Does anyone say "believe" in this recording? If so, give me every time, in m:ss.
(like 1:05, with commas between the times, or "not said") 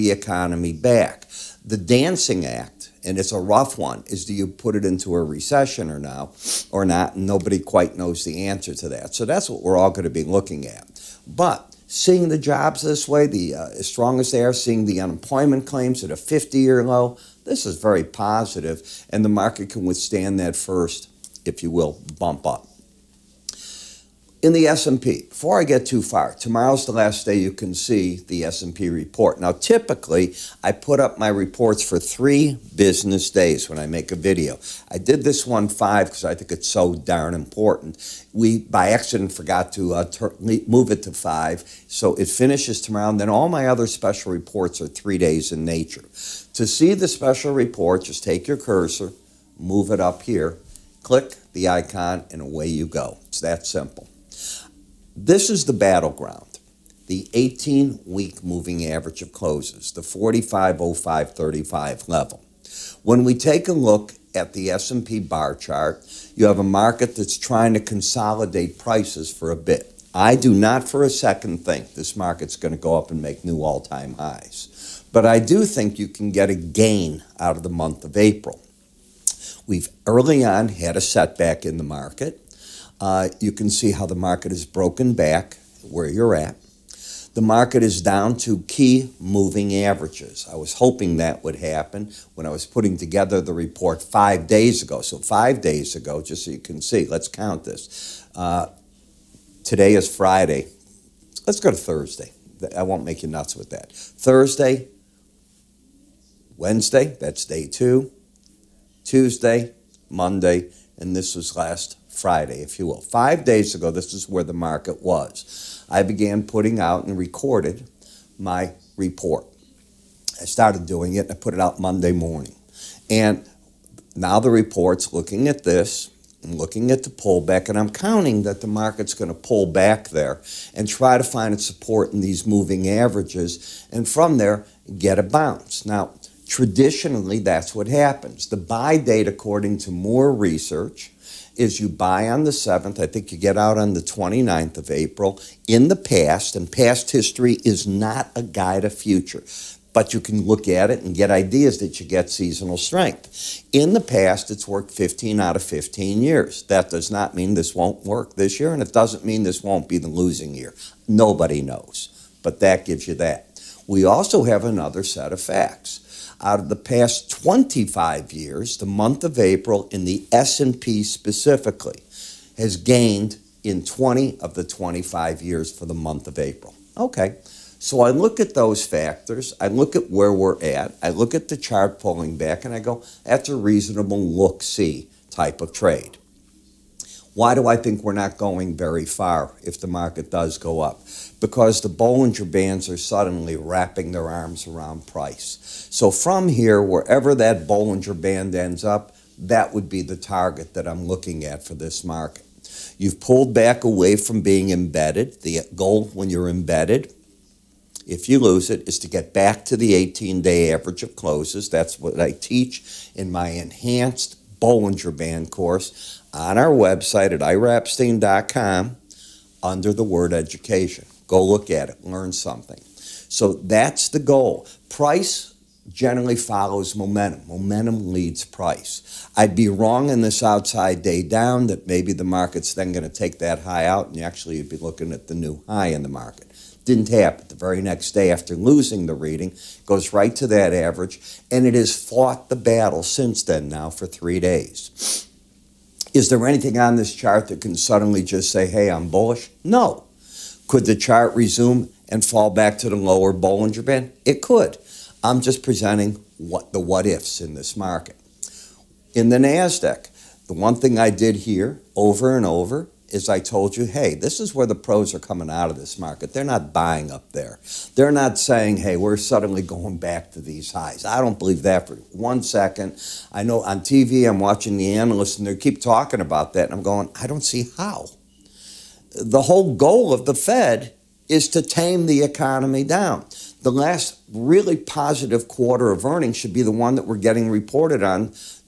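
4:31.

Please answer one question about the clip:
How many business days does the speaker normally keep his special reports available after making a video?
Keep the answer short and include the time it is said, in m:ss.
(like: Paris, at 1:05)
3, at 0:31.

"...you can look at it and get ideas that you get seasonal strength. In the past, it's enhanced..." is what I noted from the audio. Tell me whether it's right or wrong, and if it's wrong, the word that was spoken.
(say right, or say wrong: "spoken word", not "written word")
wrong: "worked", not "enhanced".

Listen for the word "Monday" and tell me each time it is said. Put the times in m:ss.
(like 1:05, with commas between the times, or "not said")
1:50, 2:01.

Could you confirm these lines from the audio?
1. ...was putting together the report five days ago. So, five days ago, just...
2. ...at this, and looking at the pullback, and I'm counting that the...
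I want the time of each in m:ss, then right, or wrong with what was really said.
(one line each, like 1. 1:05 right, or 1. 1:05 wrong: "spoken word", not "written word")
1. 1:32 right
2. 2:05 right.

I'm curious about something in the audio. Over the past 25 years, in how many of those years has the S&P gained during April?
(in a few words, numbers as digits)
20.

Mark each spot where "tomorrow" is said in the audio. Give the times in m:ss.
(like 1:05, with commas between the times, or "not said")
0:26, 0:42.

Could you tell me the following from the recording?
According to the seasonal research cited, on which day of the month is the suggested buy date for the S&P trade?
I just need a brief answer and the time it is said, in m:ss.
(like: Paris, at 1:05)
7th, at 2:22.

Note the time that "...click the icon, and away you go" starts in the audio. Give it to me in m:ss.
0:51.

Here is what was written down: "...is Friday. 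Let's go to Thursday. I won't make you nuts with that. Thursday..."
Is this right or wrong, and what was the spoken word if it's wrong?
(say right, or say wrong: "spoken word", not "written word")
right.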